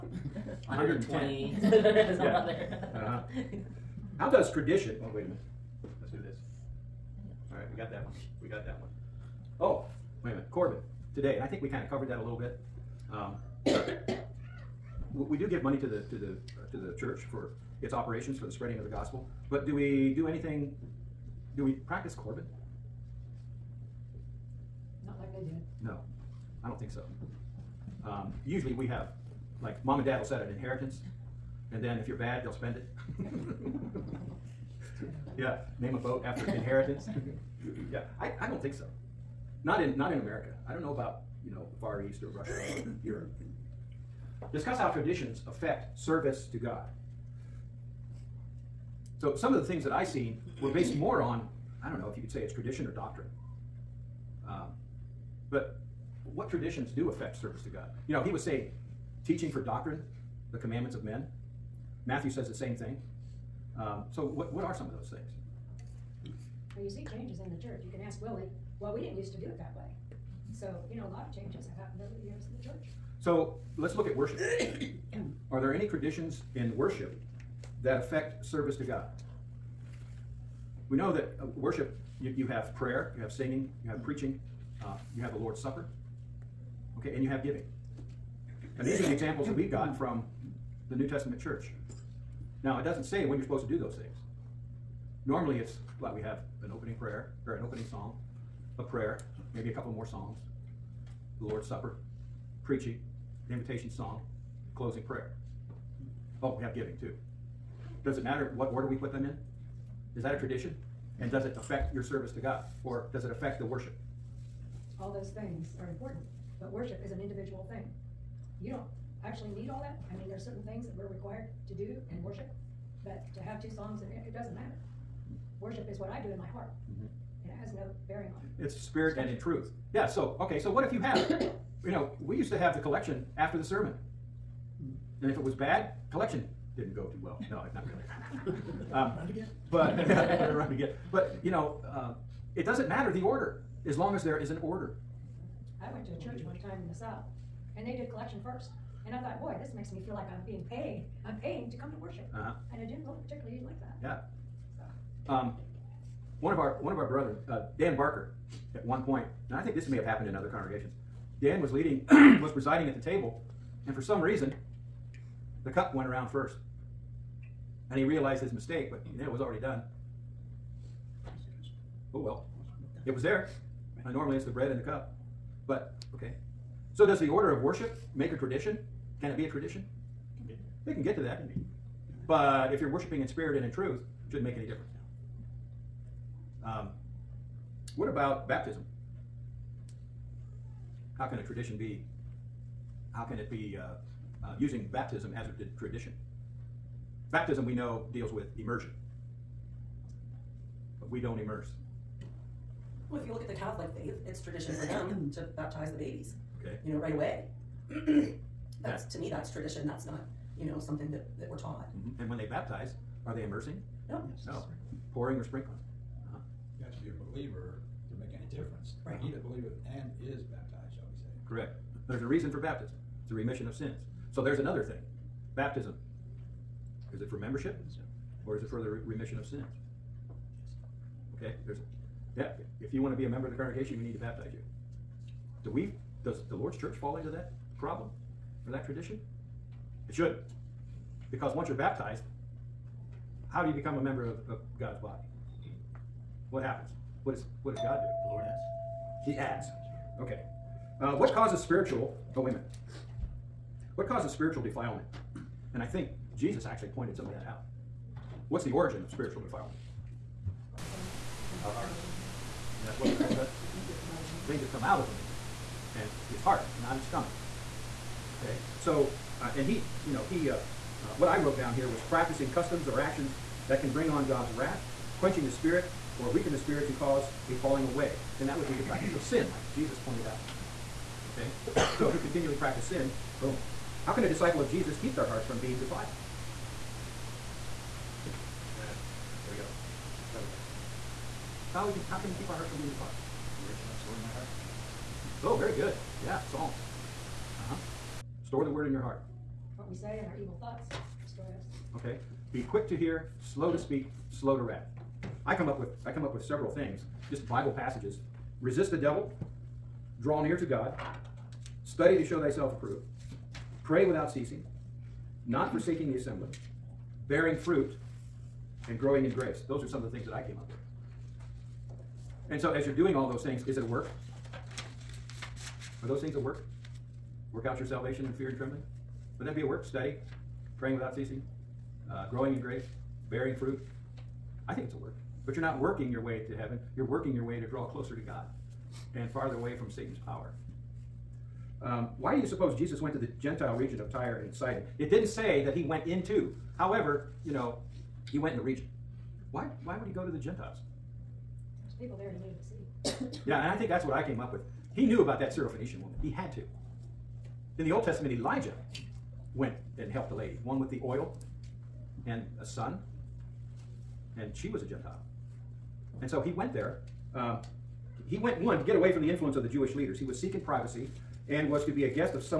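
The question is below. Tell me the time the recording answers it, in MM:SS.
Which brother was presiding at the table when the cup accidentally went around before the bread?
02:37.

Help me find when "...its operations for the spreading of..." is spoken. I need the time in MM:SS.
00:17.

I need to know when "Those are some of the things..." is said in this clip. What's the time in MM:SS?
05:19.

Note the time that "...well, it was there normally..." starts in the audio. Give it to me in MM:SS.
02:52.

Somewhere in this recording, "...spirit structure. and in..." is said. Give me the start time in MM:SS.
02:08.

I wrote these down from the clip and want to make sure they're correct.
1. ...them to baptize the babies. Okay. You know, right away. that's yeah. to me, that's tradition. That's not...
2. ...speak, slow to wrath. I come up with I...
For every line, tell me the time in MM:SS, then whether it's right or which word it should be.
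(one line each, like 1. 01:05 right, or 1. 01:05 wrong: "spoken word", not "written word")
1. 03:24 right
2. 05:03 right.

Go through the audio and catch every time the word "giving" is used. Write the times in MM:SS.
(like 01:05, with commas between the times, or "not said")
01:27, 01:46.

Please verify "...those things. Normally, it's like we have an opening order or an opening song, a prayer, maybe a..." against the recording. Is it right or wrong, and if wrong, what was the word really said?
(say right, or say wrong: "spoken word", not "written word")
wrong: "prayer", not "order".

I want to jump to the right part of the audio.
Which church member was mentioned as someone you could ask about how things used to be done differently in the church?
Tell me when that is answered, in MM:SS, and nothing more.
01:08.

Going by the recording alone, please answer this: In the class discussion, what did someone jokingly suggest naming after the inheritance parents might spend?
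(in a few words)
A boat.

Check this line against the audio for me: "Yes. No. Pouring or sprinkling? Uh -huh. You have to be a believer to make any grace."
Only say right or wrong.
wrong.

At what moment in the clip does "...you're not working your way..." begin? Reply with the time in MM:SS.
05:35.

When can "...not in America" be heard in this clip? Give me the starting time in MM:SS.
00:39.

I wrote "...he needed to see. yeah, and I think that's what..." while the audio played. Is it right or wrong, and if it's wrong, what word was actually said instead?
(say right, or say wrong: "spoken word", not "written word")
right.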